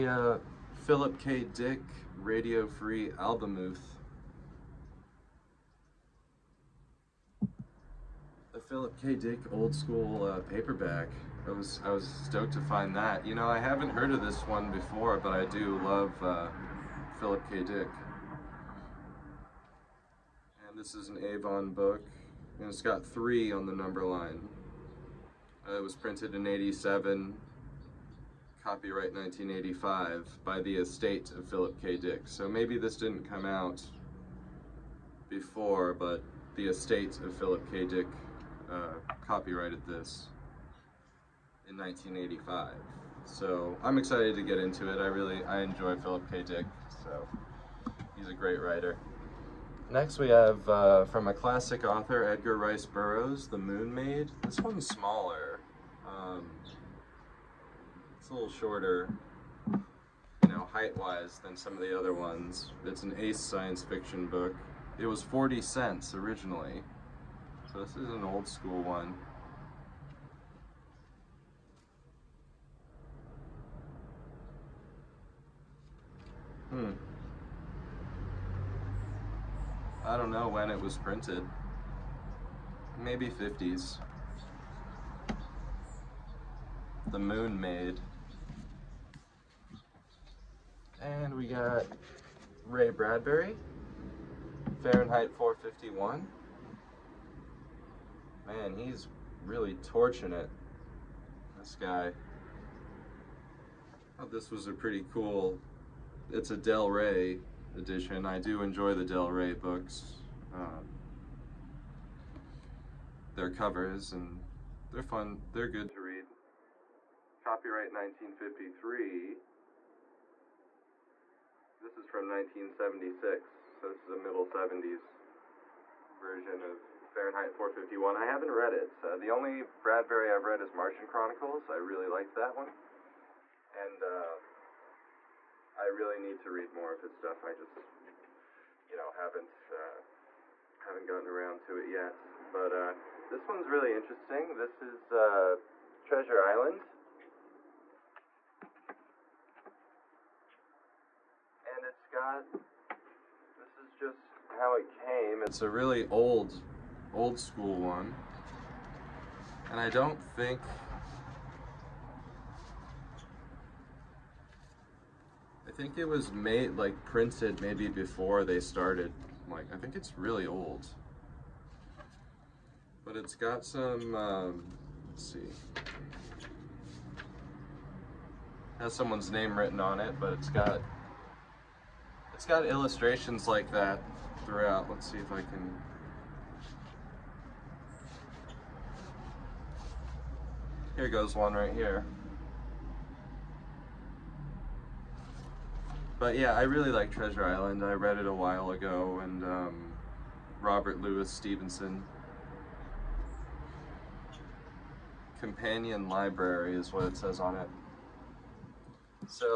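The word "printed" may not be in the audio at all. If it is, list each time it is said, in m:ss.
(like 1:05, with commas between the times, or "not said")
0:25, 1:20, 2:47.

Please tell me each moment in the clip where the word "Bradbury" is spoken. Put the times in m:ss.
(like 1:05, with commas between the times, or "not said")
1:32, 2:09.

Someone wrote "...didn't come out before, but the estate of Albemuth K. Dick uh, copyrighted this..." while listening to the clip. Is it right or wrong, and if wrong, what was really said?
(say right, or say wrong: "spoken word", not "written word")
wrong: "Philip", not "Albemuth".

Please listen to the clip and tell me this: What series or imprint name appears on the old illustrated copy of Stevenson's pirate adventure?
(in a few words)
Companion Library.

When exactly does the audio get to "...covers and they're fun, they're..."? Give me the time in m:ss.
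1:53.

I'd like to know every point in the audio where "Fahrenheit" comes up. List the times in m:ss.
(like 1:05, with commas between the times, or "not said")
1:34, 2:07.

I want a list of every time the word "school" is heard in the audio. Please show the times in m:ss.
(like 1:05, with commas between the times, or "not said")
0:09, 1:08, 2:37.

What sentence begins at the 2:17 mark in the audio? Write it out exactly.
I just, you know, haven't uh, haven't gotten around to it yet.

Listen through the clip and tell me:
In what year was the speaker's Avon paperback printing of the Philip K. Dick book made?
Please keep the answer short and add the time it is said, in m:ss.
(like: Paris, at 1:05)
1987, at 0:26.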